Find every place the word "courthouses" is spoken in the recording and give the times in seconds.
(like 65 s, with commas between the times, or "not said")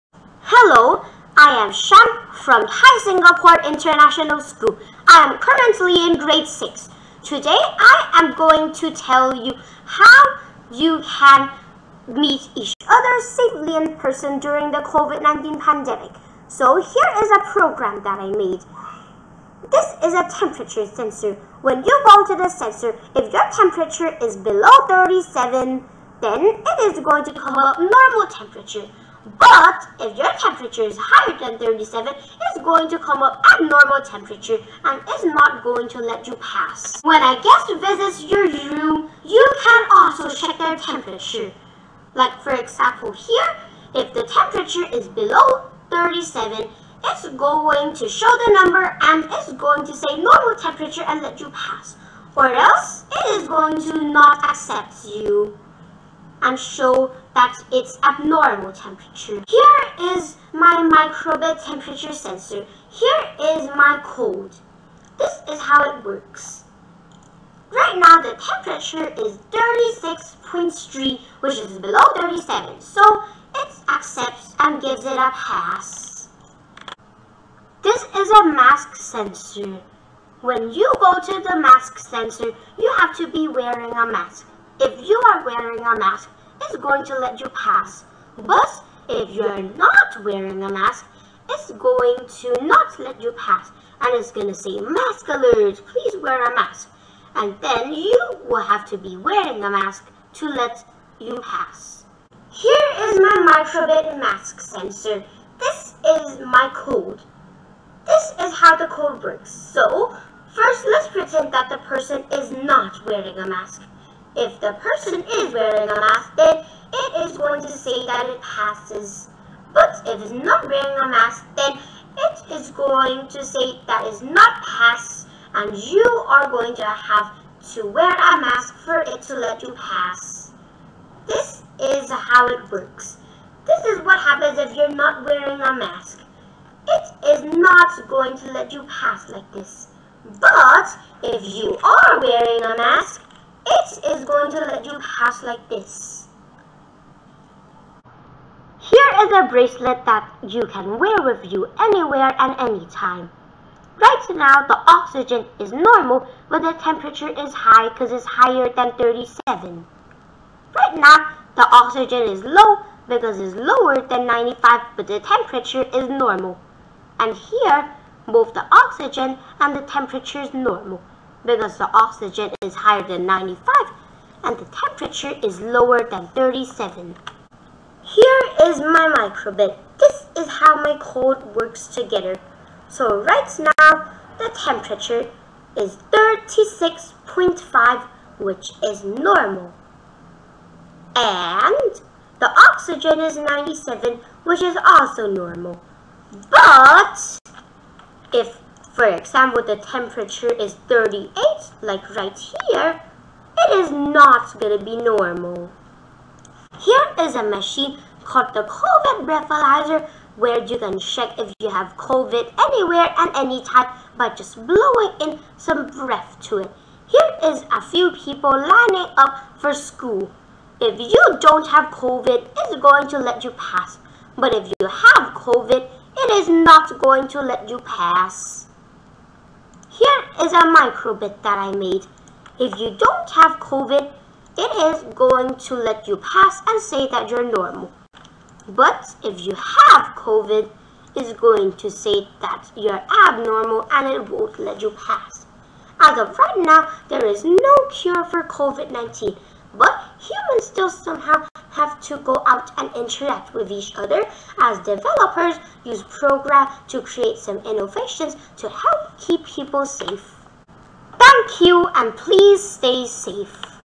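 not said.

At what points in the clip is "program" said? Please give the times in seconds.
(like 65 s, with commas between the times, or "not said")
17 s, 256 s.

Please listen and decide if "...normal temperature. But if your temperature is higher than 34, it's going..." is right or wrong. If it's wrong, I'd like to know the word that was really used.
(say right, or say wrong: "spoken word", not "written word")
wrong: "37", not "34".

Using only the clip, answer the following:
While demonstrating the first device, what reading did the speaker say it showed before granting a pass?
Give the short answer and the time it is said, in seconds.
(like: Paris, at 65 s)
36.3, at 69 s.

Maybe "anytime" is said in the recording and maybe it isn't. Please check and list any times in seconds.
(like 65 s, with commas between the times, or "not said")
152 s, 213 s.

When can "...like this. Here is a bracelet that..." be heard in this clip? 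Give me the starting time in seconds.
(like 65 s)
145 s.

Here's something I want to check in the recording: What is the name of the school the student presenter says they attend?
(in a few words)
Thai Singapore International School.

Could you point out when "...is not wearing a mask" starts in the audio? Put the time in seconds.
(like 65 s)
112 s.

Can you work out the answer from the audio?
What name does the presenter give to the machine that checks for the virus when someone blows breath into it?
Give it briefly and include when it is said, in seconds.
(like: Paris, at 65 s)
COVID breathalyzer, at 208 s.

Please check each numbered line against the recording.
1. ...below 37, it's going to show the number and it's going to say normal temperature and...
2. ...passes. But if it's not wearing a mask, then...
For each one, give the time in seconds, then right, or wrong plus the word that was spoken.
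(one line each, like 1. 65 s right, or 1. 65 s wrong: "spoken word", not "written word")
1. 45 s right
2. 118 s right.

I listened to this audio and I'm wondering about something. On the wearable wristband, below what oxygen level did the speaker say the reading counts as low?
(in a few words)
95.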